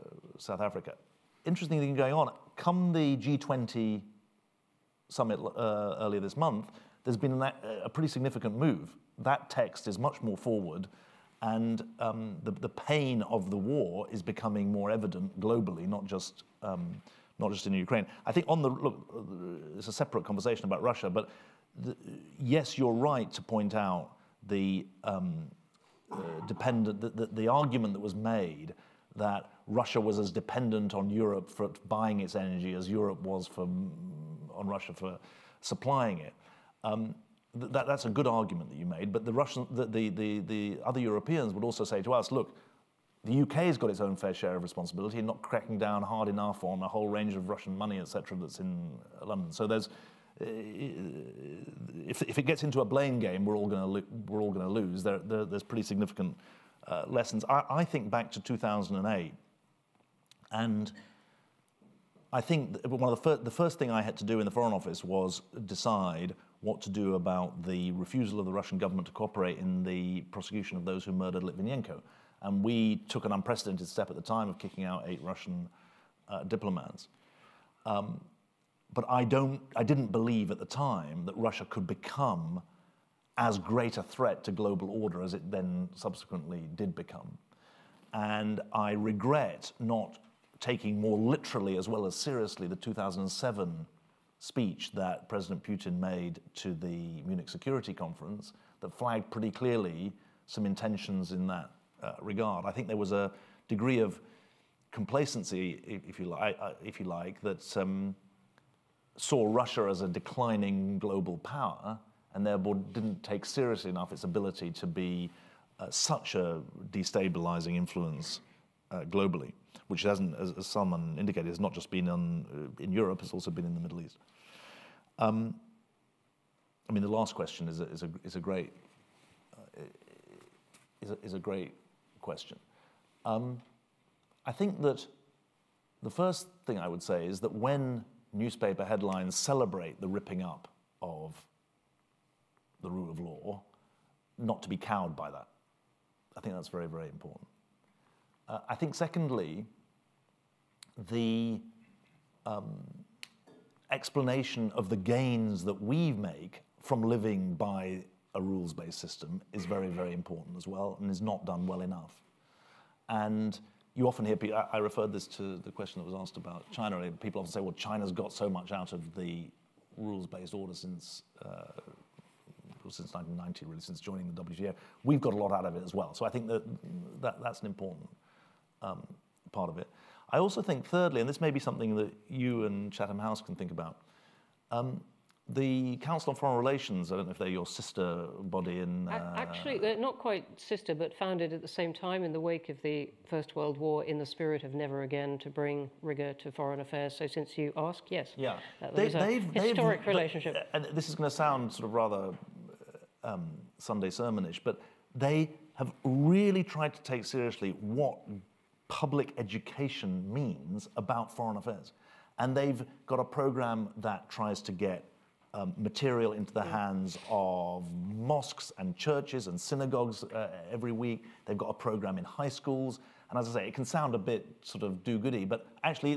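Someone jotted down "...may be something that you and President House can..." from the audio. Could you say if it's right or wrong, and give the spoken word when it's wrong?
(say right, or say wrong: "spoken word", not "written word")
wrong: "Chatham", not "President".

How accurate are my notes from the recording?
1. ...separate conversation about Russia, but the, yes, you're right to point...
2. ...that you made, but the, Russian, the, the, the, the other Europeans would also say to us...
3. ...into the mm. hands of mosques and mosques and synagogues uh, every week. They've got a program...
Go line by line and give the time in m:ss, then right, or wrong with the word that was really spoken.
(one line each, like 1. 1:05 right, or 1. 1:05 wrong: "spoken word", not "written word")
1. 0:19 right
2. 0:38 right
3. 3:36 wrong: "churches", not "mosques".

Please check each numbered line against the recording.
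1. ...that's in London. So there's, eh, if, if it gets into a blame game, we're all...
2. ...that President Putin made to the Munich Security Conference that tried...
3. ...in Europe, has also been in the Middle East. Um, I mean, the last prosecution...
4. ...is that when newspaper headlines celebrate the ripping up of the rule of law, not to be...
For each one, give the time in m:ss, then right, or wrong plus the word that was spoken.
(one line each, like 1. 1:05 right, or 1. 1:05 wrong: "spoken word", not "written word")
1. 0:48 right
2. 1:34 wrong: "flagged", not "tried"
3. 2:02 wrong: "question", not "prosecution"
4. 2:17 right.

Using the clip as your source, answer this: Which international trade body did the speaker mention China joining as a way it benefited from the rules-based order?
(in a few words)
WTO.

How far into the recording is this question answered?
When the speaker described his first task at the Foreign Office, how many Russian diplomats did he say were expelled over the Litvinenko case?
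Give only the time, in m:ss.
1:15.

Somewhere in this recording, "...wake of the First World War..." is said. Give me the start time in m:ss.
3:12.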